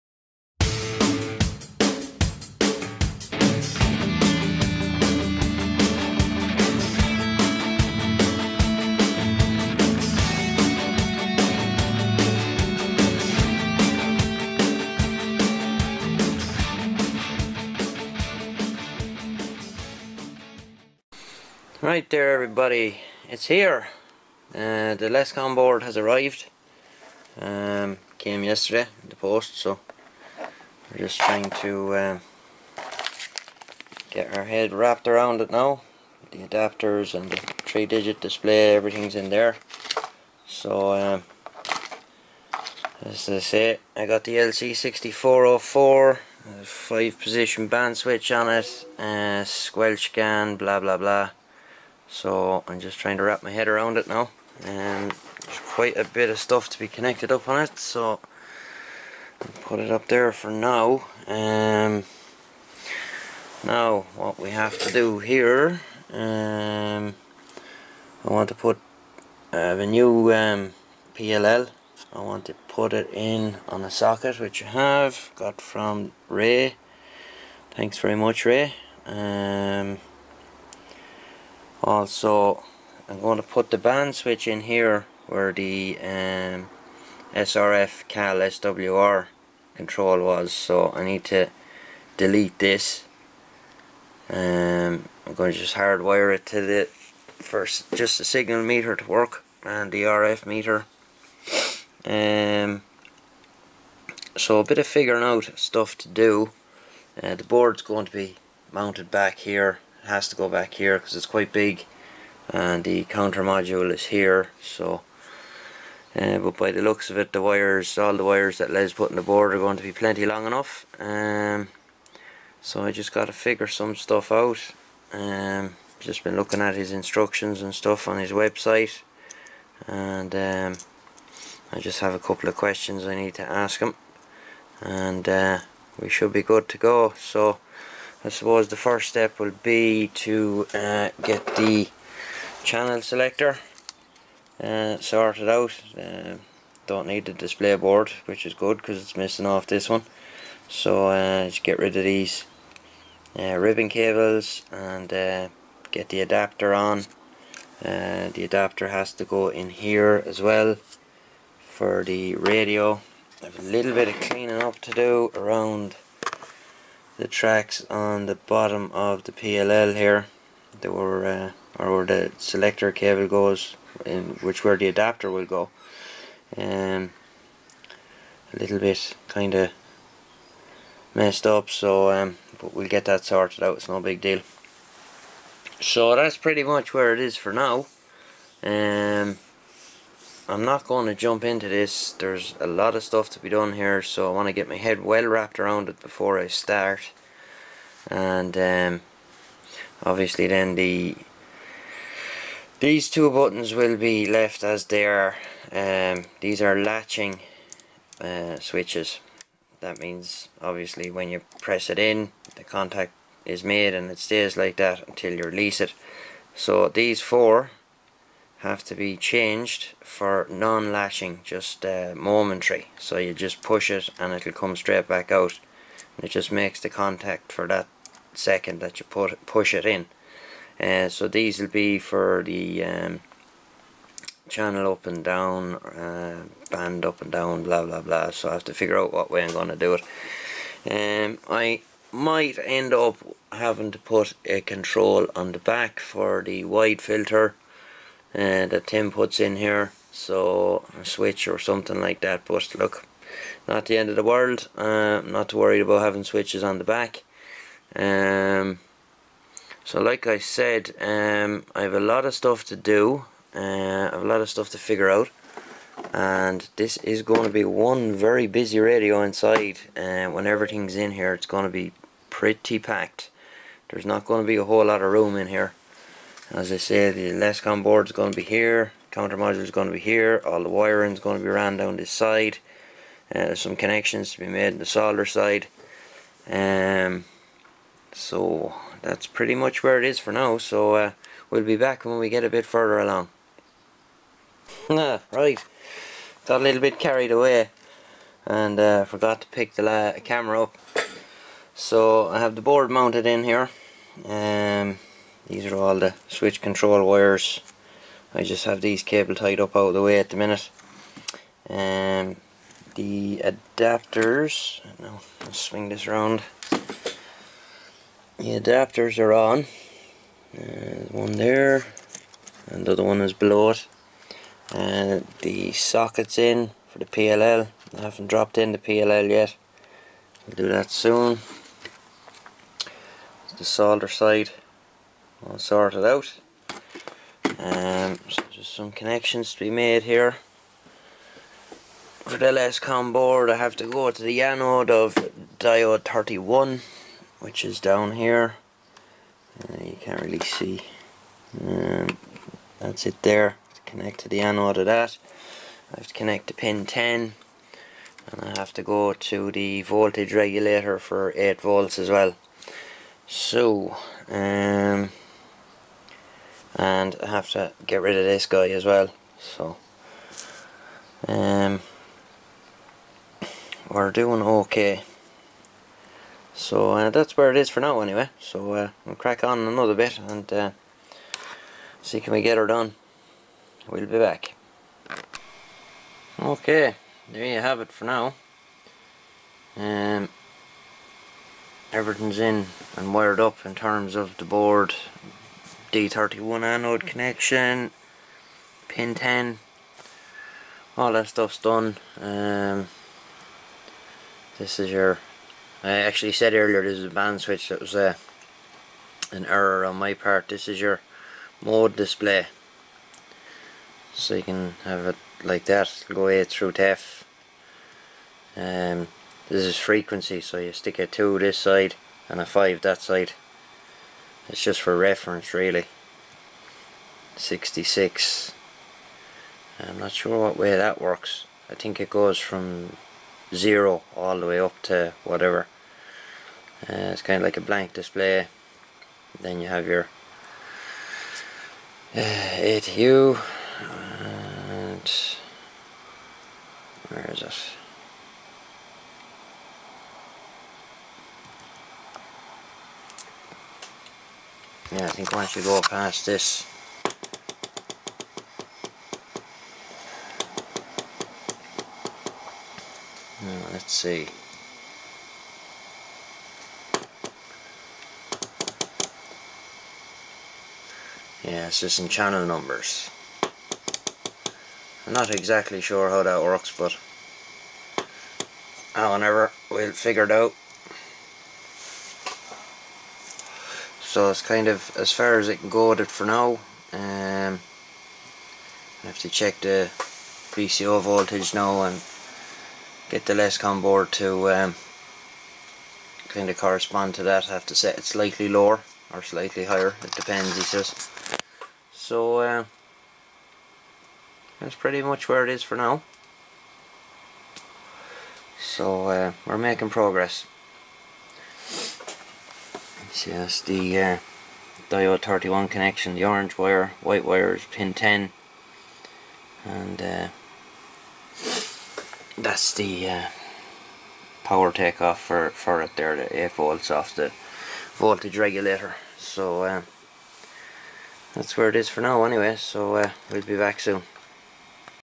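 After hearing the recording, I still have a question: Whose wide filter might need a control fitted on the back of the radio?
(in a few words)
Tim.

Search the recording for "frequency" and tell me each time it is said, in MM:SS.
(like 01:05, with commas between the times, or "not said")
06:59.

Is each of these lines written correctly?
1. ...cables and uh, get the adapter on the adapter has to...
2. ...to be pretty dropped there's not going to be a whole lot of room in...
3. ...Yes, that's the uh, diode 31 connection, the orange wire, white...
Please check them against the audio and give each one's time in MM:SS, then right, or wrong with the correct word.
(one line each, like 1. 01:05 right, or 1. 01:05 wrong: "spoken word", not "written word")
1. 02:33 right
2. 04:31 wrong: "packed", not "dropped"
3. 08:33 right.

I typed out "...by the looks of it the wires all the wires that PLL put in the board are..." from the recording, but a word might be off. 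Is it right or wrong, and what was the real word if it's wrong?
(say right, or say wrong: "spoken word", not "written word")
wrong: "Les", not "PLL".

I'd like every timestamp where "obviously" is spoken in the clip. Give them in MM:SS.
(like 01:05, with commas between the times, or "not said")
03:20, 03:30.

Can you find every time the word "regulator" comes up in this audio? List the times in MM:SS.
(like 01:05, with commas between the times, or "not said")
06:00, 08:48.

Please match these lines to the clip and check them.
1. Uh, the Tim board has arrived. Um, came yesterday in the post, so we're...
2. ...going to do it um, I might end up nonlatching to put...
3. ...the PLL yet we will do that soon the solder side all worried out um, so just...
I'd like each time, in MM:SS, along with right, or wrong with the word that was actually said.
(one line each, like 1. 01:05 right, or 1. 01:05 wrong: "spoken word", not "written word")
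1. 00:24 wrong: "Lescom", not "Tim"
2. 03:59 wrong: "having", not "nonlatching"
3. 05:28 wrong: "sorted", not "worried".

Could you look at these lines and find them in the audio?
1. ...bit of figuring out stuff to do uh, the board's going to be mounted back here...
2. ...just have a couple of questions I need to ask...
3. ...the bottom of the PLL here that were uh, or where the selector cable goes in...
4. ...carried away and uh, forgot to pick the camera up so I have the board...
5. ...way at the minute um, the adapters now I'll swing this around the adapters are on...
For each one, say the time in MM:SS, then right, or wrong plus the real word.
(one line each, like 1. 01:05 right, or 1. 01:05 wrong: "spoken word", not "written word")
1. 01:44 right
2. 02:11 right
3. 02:48 right
4. 04:56 right
5. 05:10 right.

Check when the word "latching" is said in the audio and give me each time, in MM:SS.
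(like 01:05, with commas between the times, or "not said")
03:26, 03:40.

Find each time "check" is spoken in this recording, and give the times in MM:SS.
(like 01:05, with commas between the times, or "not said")
08:09.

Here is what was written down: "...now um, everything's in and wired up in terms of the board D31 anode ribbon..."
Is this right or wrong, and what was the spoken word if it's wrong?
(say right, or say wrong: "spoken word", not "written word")
wrong: "connection", not "ribbon".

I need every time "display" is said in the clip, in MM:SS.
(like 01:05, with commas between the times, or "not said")
00:38, 02:27, 06:51, 07:17.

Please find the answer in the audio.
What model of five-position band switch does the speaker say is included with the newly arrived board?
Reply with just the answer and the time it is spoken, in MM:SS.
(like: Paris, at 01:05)
LC6404, at 00:44.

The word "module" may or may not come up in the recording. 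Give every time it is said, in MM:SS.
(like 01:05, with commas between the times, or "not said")
01:53, 04:39.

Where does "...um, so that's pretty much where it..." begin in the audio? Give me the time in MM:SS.
04:46.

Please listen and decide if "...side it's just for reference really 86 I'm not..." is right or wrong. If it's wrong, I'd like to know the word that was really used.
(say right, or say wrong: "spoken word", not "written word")
wrong: "66", not "86".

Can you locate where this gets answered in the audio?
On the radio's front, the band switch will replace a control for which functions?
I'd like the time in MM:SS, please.
01:27.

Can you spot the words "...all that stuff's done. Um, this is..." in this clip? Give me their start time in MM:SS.
06:40.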